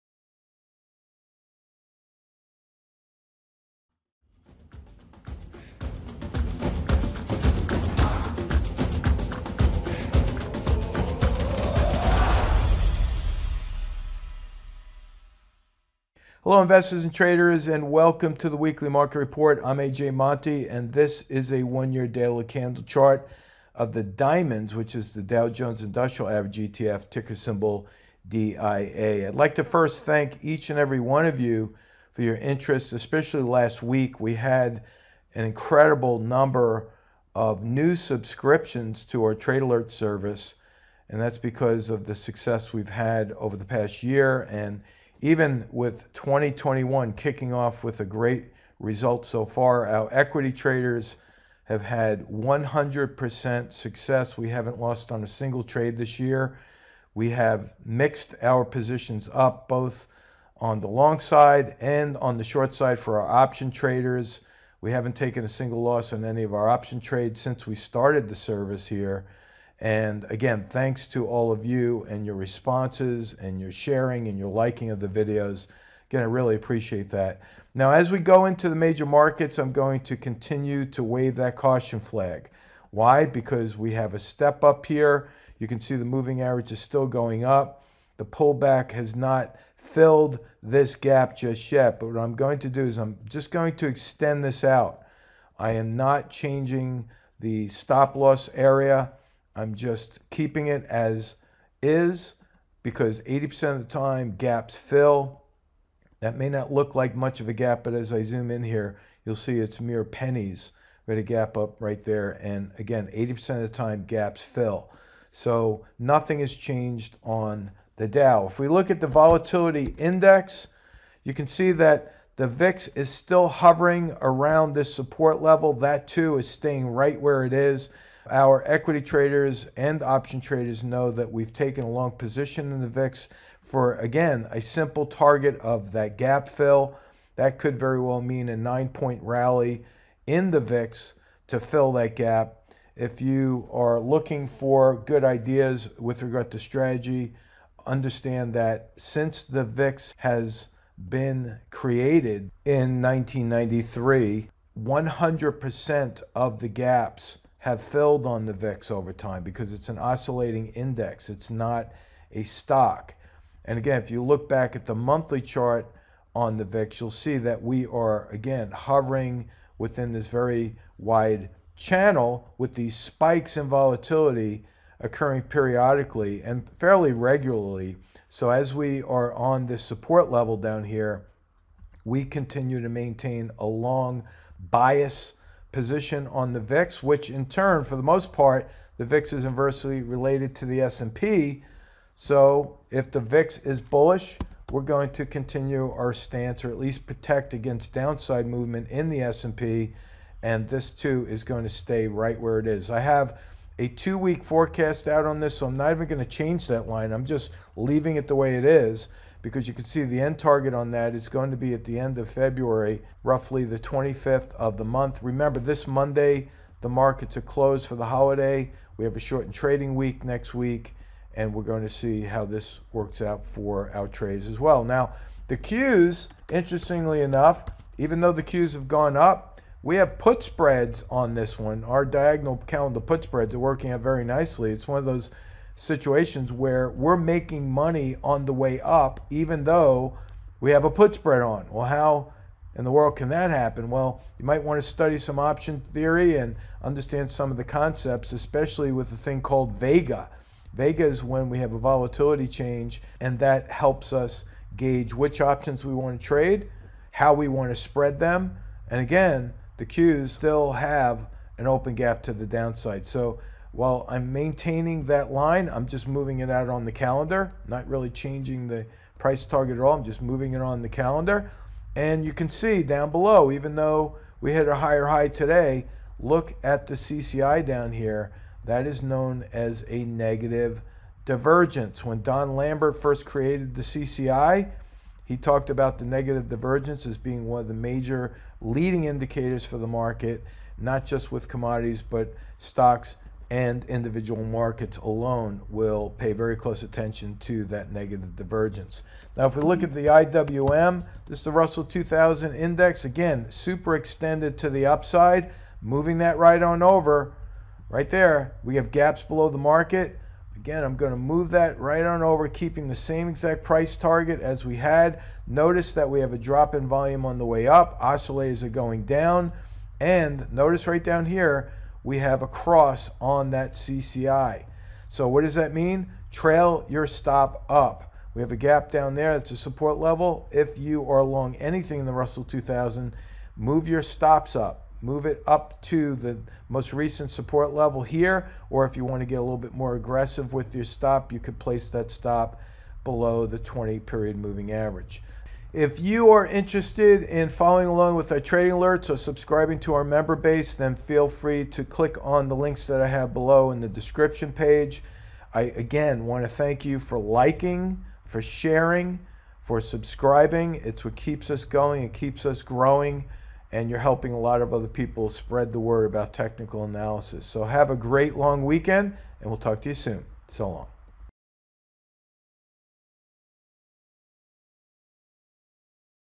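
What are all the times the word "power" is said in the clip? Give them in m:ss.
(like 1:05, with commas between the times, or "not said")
not said.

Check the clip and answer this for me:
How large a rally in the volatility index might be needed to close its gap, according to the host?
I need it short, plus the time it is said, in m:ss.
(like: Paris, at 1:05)
9 points, at 2:18.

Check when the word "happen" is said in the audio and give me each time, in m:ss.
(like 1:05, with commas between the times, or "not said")
4:03.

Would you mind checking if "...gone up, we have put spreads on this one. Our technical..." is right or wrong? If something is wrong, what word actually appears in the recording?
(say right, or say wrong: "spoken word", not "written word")
wrong: "diagonal", not "technical".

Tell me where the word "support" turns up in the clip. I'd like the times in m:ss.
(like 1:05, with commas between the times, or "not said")
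2:04, 2:59, 5:29, 5:37.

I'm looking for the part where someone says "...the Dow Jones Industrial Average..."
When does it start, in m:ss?
0:25.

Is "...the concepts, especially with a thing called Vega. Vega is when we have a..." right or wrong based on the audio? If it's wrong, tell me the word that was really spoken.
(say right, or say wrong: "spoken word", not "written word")
right.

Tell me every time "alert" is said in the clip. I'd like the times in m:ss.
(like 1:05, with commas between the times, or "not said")
0:39, 5:48.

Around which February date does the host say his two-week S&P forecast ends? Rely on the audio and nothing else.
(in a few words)
25th.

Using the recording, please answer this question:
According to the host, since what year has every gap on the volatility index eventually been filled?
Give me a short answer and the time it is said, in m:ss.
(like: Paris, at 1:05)
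1993, at 2:33.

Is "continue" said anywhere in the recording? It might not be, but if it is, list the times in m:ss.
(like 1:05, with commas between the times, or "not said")
1:20, 3:02, 3:15.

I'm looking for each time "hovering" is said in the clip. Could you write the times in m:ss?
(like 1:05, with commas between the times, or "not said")
2:03, 2:48.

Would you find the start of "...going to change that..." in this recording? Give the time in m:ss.
3:26.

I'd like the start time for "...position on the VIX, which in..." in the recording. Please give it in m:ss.
3:05.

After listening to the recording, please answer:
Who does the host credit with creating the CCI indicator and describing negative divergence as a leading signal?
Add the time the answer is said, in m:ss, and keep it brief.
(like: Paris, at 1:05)
Don Lambert, at 4:42.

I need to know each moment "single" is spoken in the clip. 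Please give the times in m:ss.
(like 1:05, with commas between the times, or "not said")
0:55, 1:05.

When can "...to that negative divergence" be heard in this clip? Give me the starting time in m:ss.
4:57.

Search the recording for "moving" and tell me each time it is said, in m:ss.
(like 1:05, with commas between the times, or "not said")
1:26, 4:26, 4:30, 5:05, 5:44.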